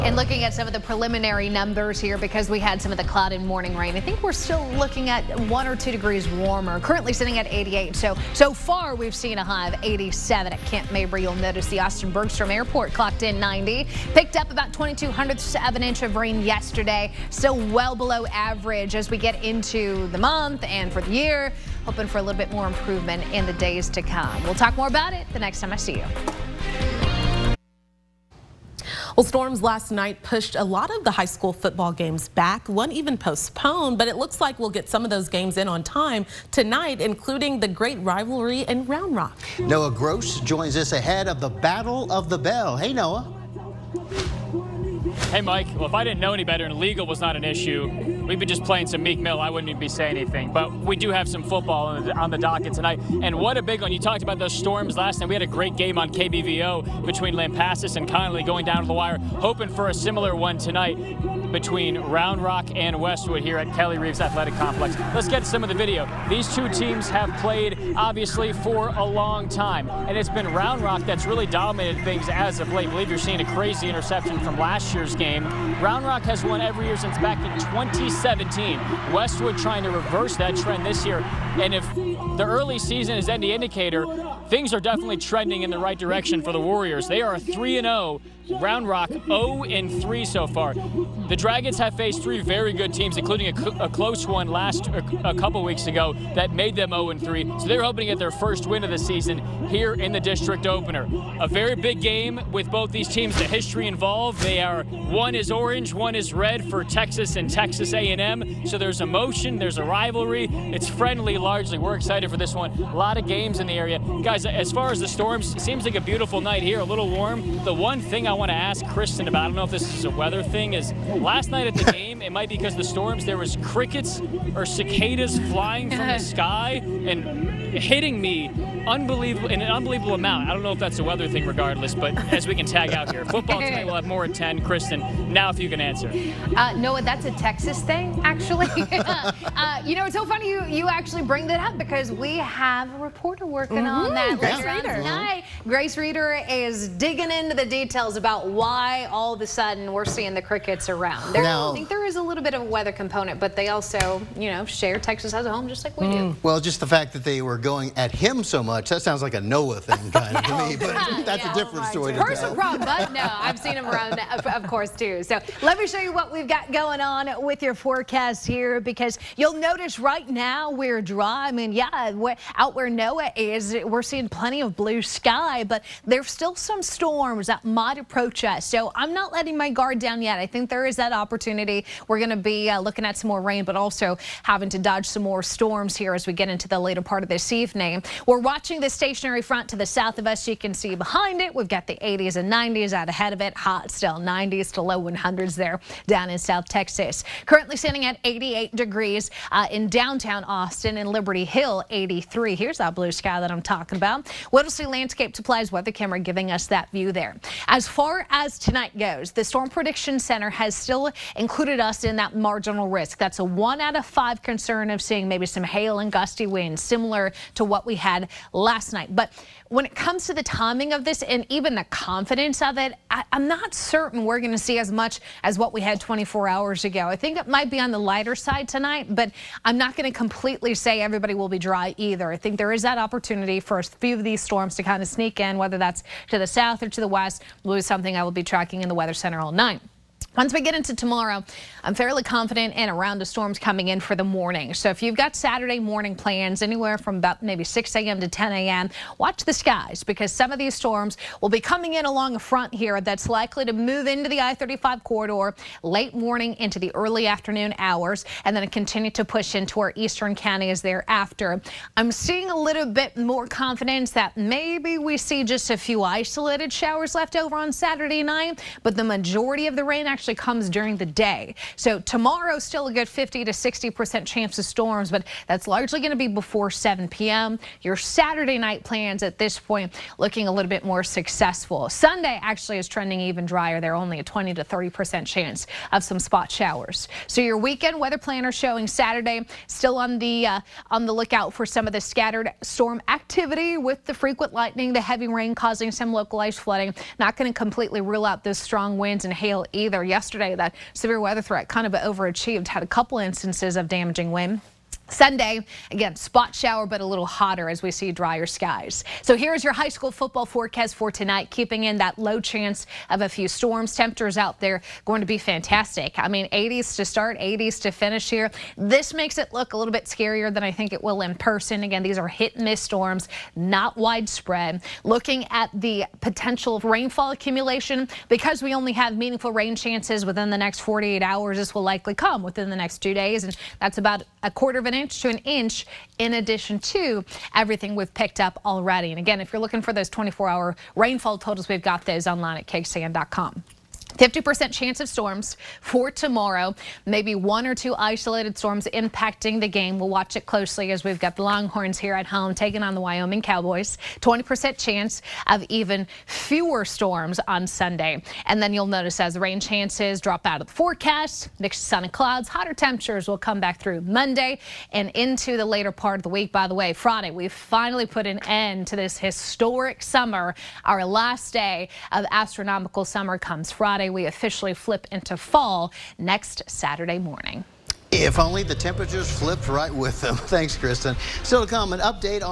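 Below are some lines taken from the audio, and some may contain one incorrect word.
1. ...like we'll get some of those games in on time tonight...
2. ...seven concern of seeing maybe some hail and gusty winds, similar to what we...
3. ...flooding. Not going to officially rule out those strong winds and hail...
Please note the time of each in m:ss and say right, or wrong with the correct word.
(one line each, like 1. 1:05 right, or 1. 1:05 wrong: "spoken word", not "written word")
1. 0:34 right
2. 3:34 wrong: "five", not "seven"
3. 4:56 wrong: "completely", not "officially".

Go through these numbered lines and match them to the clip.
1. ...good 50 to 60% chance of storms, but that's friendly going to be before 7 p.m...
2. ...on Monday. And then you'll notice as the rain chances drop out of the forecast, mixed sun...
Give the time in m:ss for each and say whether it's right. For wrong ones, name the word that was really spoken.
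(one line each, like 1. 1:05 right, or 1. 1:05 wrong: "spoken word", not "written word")
1. 4:32 wrong: "largely", not "friendly"
2. 5:57 wrong: "Sunday", not "Monday".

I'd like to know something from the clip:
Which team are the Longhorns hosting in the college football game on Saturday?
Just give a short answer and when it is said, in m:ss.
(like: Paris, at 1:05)
Wyoming Cowboys, at 5:53.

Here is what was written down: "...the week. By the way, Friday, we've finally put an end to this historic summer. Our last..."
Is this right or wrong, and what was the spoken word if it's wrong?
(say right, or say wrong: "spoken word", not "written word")
right.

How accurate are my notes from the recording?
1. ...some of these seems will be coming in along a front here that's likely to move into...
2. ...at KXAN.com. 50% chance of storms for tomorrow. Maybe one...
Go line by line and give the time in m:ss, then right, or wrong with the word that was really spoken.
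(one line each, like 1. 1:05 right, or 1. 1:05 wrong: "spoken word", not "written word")
1. 4:10 wrong: "storms", not "seems"
2. 5:42 right.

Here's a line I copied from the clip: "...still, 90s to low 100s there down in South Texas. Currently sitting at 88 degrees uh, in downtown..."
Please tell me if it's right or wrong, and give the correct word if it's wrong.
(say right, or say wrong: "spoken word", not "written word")
right.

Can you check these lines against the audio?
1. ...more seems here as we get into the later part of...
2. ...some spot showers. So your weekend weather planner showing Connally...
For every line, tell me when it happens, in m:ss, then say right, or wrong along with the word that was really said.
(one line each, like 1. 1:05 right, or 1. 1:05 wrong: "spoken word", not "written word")
1. 3:05 wrong: "storms", not "seems"
2. 4:46 wrong: "Saturday", not "Connally".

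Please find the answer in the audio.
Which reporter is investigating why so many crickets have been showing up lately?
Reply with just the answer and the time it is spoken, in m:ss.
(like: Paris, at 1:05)
Grace Reader, at 2:25.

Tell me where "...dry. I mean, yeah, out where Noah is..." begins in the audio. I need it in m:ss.
2:51.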